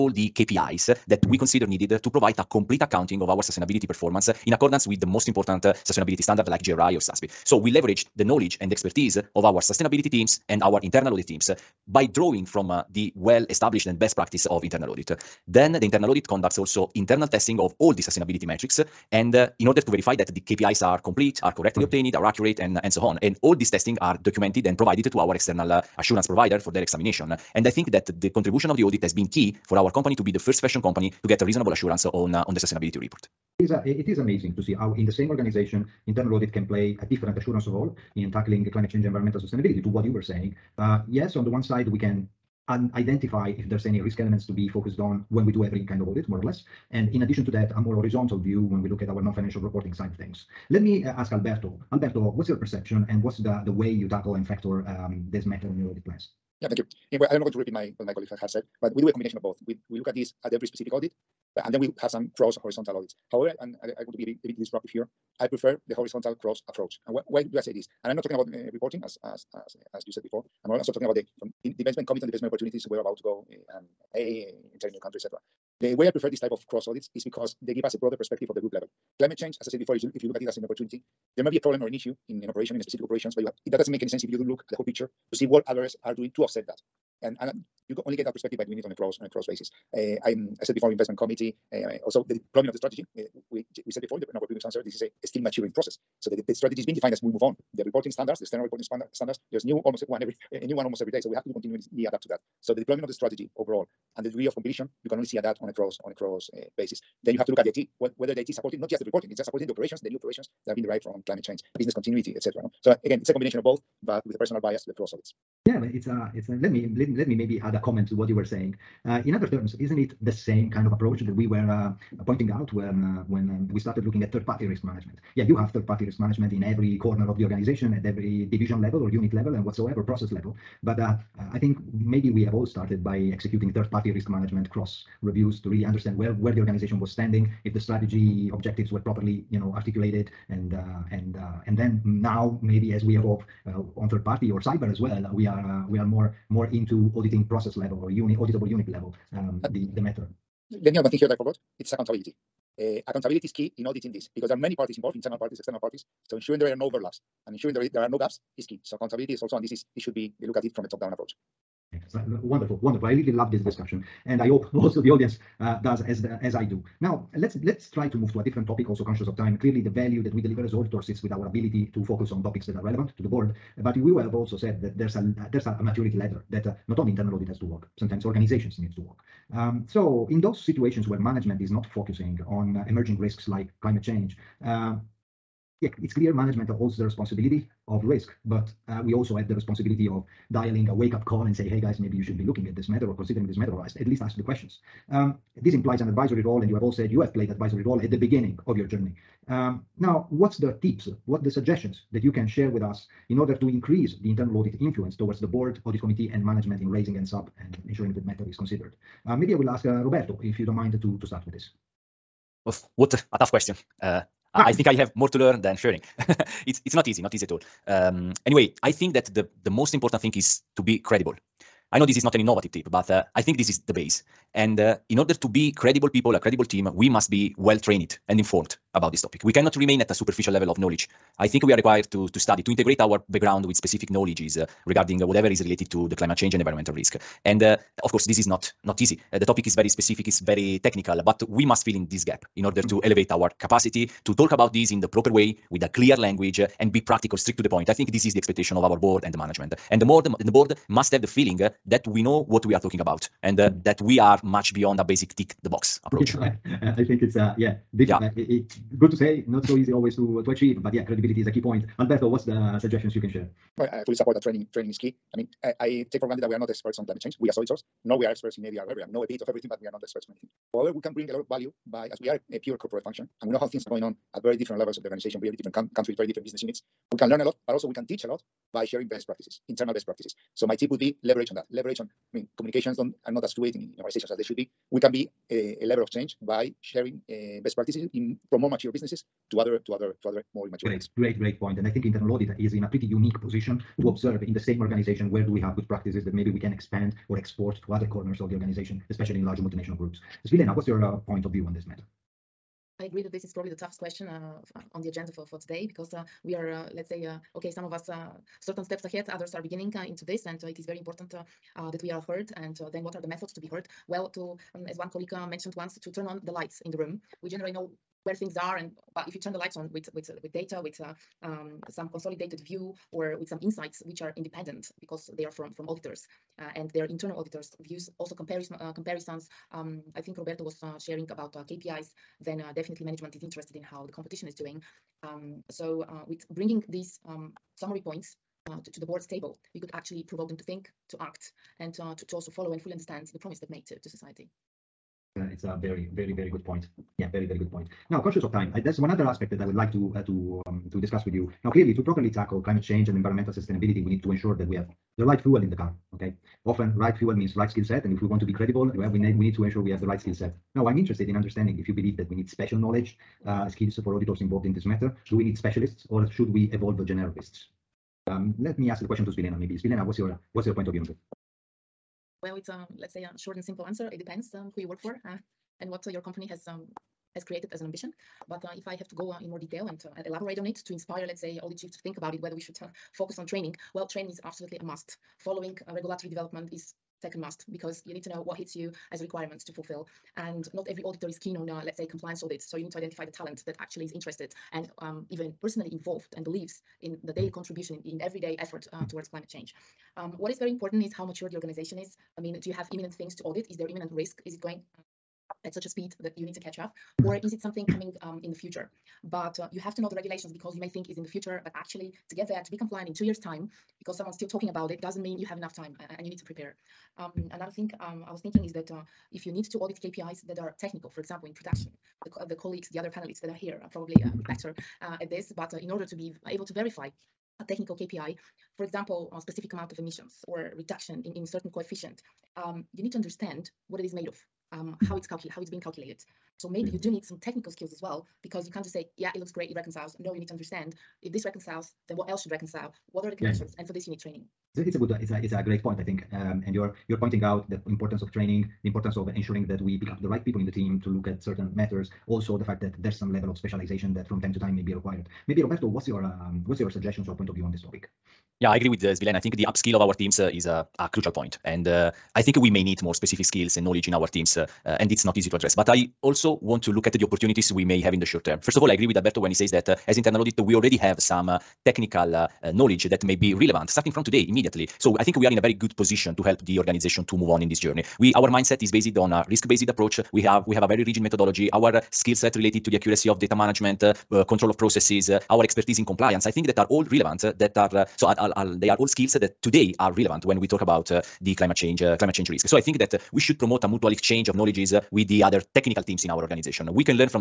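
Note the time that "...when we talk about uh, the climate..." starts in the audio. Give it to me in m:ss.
8:10.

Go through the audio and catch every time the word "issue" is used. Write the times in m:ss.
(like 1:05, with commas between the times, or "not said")
1:21.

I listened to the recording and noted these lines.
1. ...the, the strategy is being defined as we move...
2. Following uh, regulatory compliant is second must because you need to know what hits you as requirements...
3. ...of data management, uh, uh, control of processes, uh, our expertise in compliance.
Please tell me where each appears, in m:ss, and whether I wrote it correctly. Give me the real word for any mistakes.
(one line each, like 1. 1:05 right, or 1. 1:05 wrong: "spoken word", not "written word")
1. 1:36 right
2. 6:25 wrong: "development", not "compliant"
3. 8:03 right.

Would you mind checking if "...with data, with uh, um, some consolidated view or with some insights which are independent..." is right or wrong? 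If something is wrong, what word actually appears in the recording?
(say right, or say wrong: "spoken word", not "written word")
right.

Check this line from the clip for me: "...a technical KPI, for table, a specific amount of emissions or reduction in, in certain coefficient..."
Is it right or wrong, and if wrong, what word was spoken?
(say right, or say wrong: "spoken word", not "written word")
wrong: "example", not "table".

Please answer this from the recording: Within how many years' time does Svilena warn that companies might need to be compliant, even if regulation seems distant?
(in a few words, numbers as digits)
2.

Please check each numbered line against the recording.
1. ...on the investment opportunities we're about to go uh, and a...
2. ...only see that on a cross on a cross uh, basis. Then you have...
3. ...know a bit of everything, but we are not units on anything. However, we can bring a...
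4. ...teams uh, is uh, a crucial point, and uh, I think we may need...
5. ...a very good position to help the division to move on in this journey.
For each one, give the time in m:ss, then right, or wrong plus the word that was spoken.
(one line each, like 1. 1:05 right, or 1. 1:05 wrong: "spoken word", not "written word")
1. 1:12 right
2. 1:45 right
3. 4:29 wrong: "experts", not "units"
4. 7:40 right
5. 7:55 wrong: "organization", not "division".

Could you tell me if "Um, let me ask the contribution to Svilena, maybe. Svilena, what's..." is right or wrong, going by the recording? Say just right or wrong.
wrong.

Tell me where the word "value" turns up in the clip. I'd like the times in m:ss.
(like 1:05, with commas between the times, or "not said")
2:49, 4:31.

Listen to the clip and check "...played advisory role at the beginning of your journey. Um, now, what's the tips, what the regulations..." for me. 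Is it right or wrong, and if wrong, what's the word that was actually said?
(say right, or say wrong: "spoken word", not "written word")
wrong: "suggestions", not "regulations".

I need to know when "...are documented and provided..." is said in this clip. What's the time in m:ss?
0:24.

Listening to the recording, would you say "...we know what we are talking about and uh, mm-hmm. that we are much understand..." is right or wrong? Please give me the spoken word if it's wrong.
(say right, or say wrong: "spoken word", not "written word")
wrong: "beyond", not "understand".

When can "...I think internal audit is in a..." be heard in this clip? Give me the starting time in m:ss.
4:51.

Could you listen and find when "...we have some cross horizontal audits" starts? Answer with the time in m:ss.
1:01.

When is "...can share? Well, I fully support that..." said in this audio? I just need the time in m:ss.
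4:23.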